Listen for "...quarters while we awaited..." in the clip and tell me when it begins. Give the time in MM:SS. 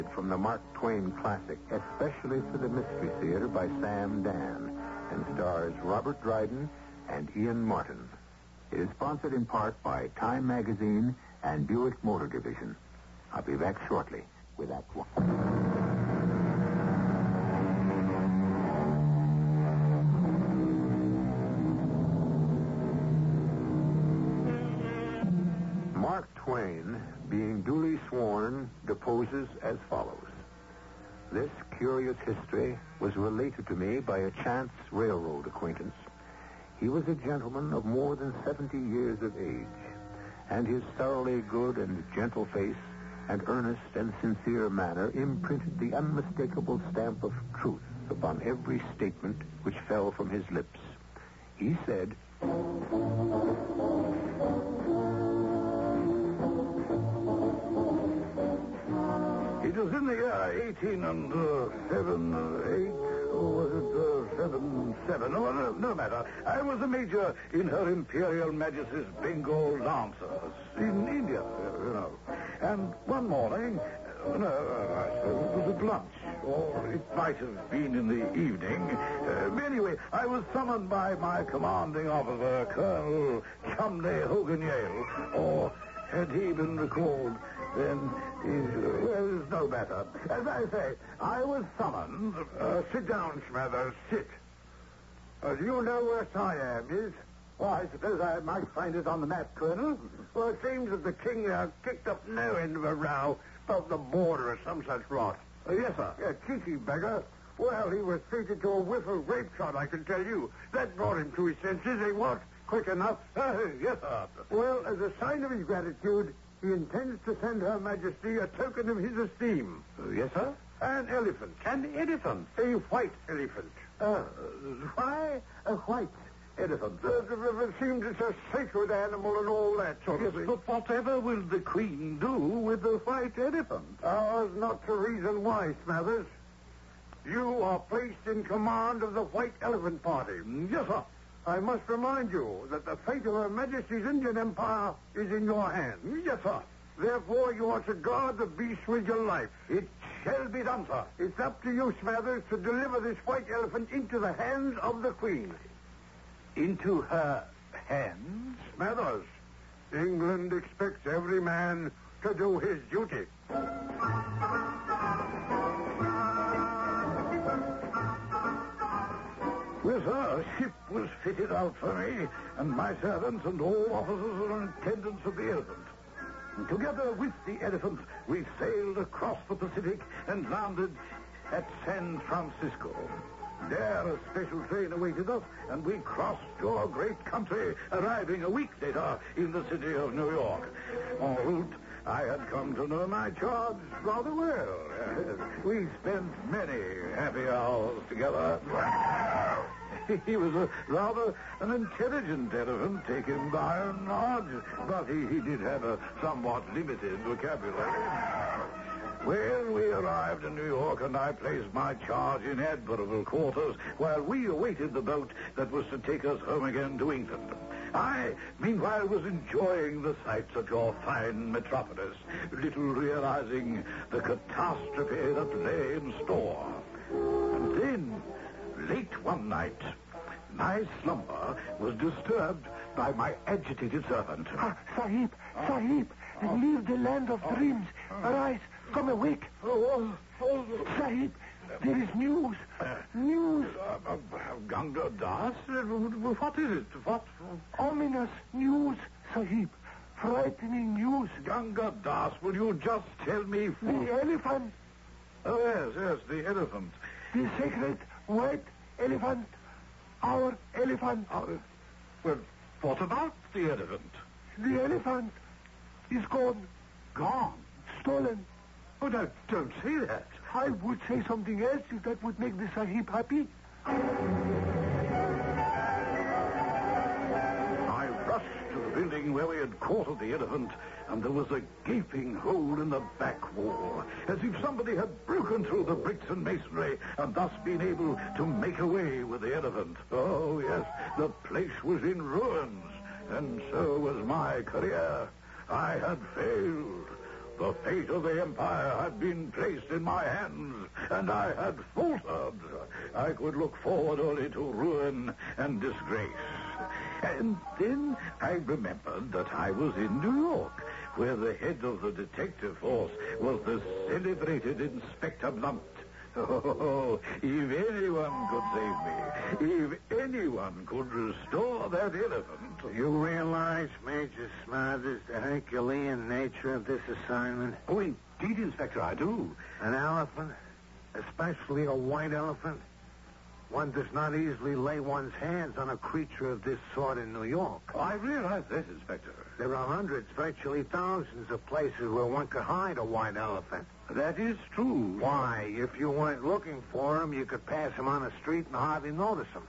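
03:33.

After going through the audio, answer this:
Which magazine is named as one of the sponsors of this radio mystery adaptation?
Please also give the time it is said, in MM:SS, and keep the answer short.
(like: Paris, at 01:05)
Time, at 00:10.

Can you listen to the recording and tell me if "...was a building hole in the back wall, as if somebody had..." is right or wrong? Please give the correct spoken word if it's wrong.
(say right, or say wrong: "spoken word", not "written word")
wrong: "gaping", not "building".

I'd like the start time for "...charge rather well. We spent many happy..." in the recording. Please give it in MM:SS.
03:13.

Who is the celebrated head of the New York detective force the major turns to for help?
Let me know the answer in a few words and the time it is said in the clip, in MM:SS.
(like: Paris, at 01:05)
Inspector Blunt, at 05:14.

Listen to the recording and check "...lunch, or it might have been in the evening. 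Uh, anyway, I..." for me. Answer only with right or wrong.
right.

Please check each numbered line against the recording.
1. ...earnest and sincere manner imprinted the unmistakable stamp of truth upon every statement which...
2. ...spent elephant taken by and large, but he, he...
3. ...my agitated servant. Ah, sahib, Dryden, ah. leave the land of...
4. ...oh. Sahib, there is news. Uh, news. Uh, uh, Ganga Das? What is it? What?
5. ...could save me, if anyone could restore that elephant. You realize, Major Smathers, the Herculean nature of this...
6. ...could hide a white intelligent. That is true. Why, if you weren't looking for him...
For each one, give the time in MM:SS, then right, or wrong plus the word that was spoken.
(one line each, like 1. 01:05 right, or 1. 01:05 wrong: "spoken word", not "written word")
1. 00:43 right
2. 03:21 wrong: "intelligent", not "spent"
3. 03:53 wrong: "Sahib", not "Dryden"
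4. 04:00 right
5. 05:18 right
6. 05:42 wrong: "elephant", not "intelligent".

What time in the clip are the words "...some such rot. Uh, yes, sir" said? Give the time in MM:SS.
01:44.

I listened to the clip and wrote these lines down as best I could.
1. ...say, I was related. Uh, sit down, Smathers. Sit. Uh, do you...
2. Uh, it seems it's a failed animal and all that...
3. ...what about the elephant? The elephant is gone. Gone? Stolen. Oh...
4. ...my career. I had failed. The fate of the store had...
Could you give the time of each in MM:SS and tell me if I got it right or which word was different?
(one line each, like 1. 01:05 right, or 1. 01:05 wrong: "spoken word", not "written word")
1. 01:30 wrong: "summoned", not "related"
2. 02:07 wrong: "sacred", not "failed"
3. 04:22 right
4. 04:54 wrong: "empire", not "store".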